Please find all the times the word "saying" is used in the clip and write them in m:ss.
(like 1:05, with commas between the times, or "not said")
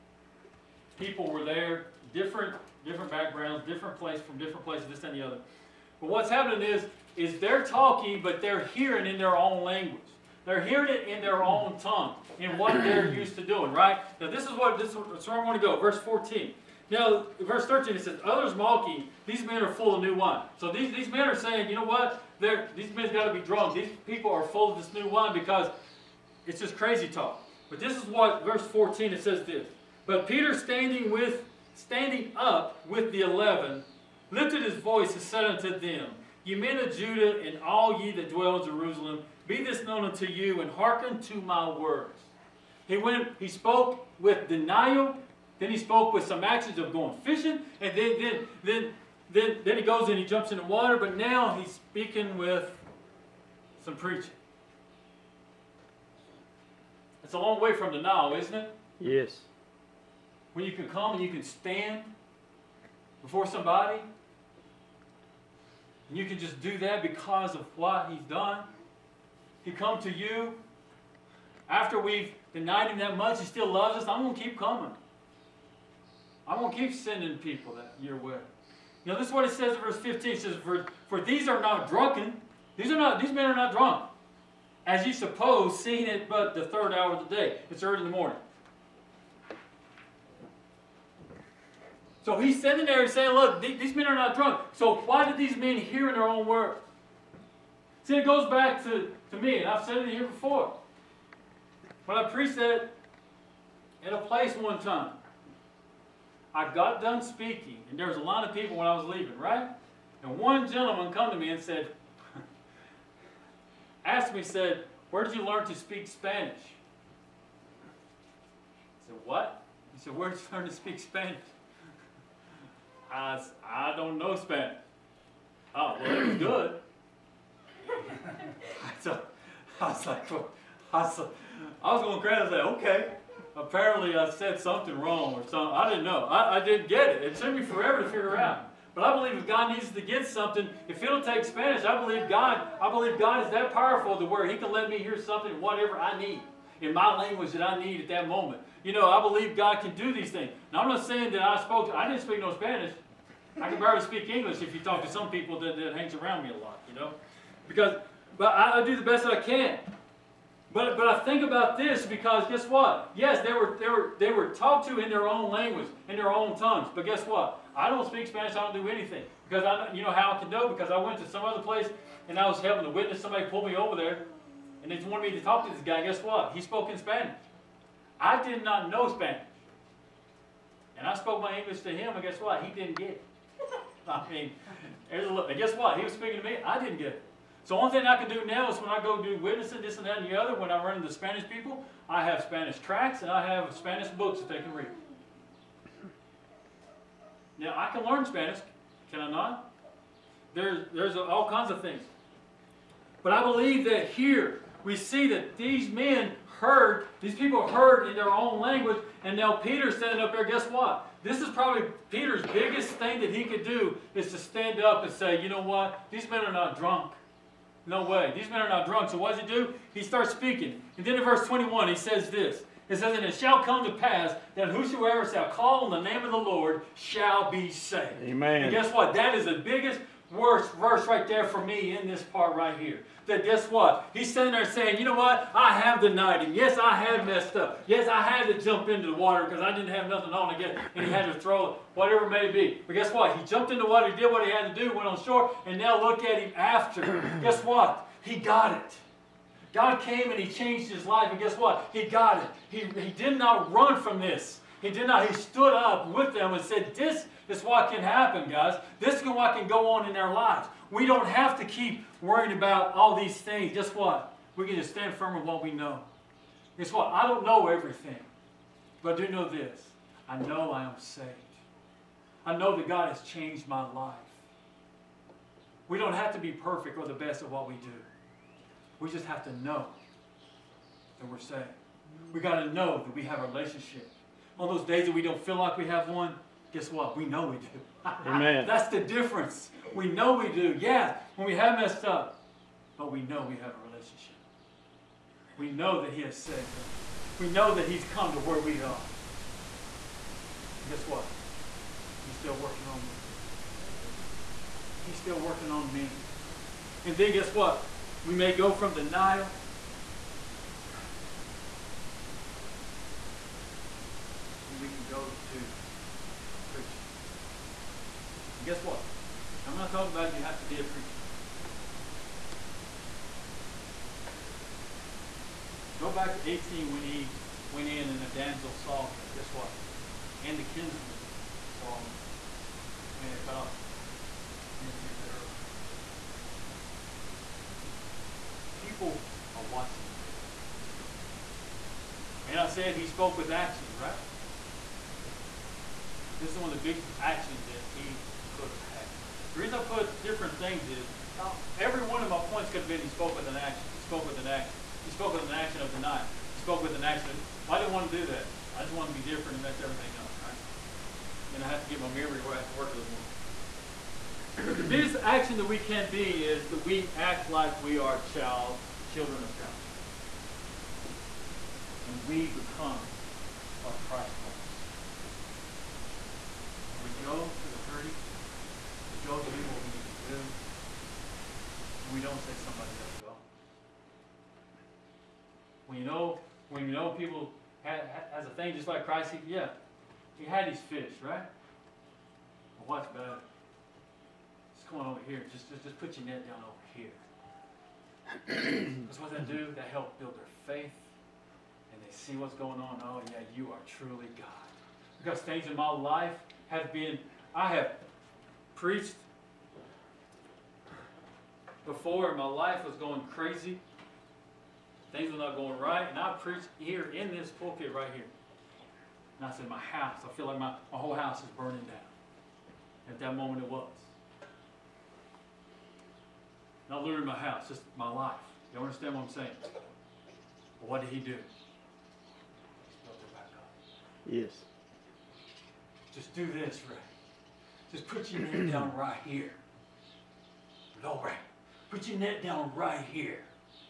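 0:21, 1:33, 2:31, 3:54, 7:09.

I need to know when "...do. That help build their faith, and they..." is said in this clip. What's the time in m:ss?
6:39.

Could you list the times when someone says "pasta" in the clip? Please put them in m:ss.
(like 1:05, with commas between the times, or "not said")
not said.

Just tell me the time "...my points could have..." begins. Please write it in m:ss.
5:52.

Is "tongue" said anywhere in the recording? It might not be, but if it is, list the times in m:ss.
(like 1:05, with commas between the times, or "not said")
0:11, 2:46.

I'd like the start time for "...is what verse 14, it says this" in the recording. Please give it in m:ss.
0:27.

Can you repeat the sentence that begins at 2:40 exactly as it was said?
But, but I think about this because guess what?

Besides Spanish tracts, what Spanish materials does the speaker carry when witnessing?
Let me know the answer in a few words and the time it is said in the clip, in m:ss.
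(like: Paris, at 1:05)
Spanish books, at 3:13.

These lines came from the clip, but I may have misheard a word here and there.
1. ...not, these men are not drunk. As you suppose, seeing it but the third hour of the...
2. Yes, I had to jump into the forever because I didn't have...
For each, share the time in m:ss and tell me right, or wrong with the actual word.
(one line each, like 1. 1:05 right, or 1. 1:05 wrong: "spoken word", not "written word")
1. 1:22 right
2. 3:57 wrong: "water", not "forever".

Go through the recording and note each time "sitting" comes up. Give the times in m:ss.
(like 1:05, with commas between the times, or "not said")
1:32, 3:54.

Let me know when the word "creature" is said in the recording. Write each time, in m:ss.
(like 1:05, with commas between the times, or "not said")
not said.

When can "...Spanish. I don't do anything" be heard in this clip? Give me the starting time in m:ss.
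2:48.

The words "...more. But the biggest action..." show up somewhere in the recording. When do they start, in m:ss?
6:03.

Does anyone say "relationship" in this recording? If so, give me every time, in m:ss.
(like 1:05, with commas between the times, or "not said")
4:43, 4:53.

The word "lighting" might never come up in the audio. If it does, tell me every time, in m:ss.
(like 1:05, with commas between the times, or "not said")
not said.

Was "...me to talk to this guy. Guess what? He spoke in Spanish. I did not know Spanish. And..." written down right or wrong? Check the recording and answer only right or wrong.
right.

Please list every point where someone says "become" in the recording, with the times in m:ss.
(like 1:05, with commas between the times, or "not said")
6:12.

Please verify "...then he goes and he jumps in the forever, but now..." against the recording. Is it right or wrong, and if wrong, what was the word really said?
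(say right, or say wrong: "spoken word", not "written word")
wrong: "water", not "forever".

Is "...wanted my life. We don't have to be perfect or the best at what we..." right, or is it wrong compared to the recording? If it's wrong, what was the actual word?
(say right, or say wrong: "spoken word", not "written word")
wrong: "changed", not "wanted".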